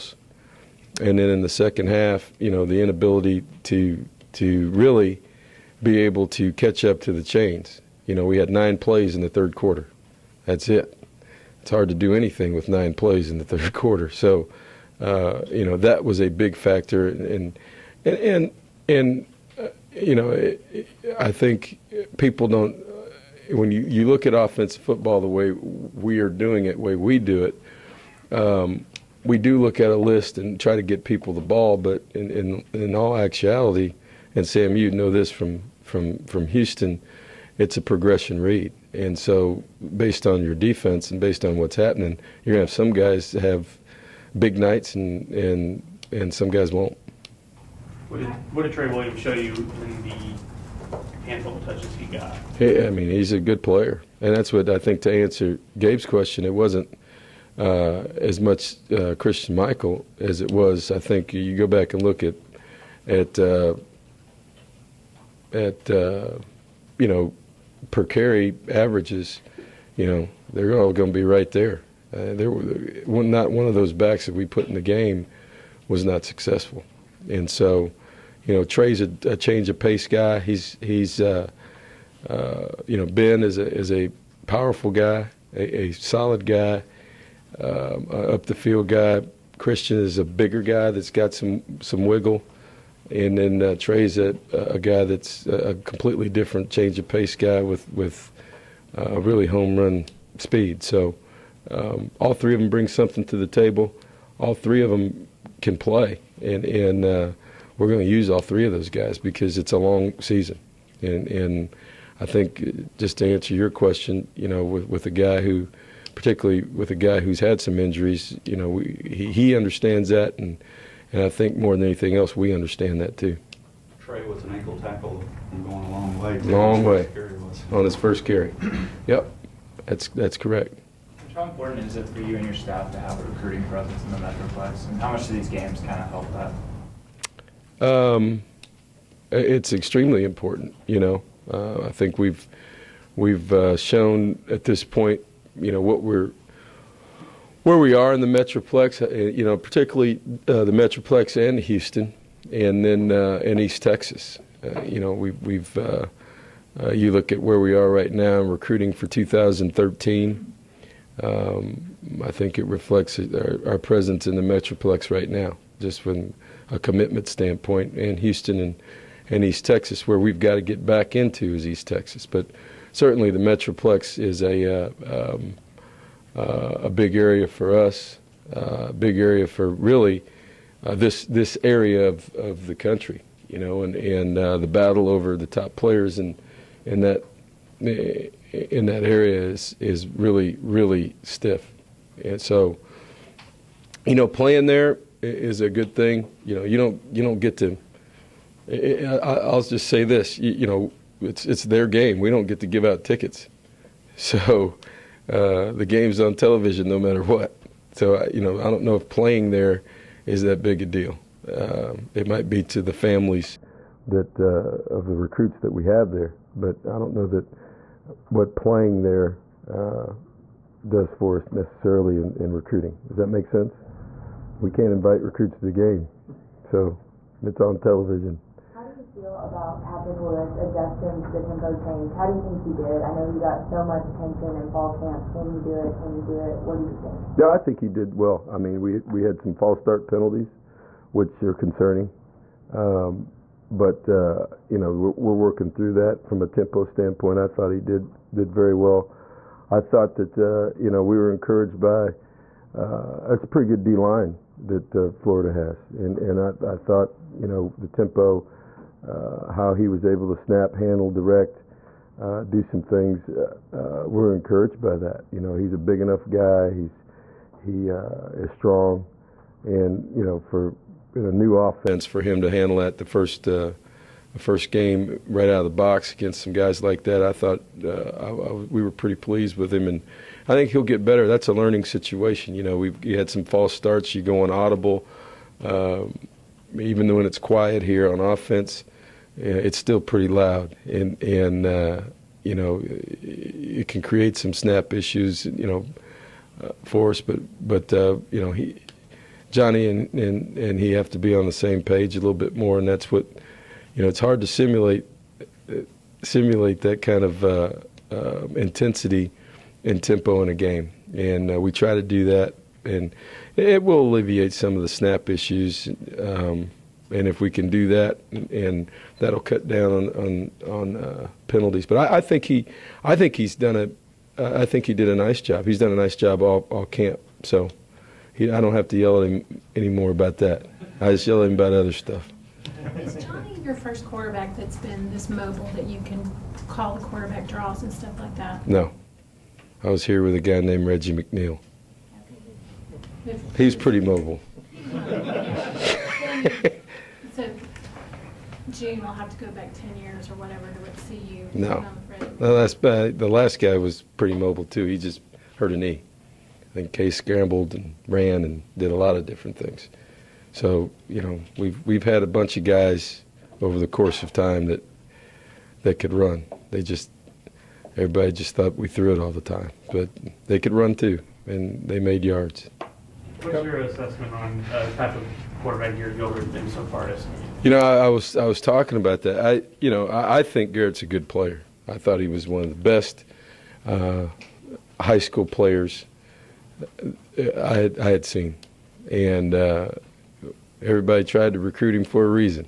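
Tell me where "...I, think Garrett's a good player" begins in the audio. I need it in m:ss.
6:20.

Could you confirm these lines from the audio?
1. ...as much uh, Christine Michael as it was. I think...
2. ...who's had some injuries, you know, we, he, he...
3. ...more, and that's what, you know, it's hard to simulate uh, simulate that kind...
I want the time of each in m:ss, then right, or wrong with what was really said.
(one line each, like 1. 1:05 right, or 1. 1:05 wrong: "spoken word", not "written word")
1. 0:58 right
2. 1:57 right
3. 5:02 right.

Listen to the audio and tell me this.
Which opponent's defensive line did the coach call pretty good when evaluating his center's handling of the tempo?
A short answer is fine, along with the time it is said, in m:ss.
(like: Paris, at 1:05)
Florida, at 4:15.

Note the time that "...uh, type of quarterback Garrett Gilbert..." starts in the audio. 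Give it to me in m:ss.
6:14.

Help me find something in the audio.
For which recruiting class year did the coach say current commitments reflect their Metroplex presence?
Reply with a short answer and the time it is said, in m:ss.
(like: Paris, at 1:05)
2013, at 2:39.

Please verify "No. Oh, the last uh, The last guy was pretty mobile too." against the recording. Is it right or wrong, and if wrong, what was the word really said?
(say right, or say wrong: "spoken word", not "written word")
right.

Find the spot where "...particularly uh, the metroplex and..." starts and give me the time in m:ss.
2:29.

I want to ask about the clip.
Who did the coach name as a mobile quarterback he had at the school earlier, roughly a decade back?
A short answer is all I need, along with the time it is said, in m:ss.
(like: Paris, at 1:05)
Reggie McNeal, at 5:40.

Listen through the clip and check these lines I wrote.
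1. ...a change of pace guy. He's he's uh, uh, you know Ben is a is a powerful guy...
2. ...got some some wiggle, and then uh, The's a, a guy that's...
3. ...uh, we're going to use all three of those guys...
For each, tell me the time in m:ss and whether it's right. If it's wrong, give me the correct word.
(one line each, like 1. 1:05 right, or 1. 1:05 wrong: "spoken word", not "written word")
1. 1:19 right
2. 1:31 wrong: "Trey", not "The"
3. 1:47 right.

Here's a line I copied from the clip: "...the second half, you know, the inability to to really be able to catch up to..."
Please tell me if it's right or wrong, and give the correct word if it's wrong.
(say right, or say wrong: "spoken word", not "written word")
right.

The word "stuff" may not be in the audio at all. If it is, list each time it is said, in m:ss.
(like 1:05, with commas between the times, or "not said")
5:31, 5:37.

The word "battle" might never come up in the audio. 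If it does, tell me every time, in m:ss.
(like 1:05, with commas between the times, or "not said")
3:04.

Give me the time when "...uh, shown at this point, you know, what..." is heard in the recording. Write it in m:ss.
2:23.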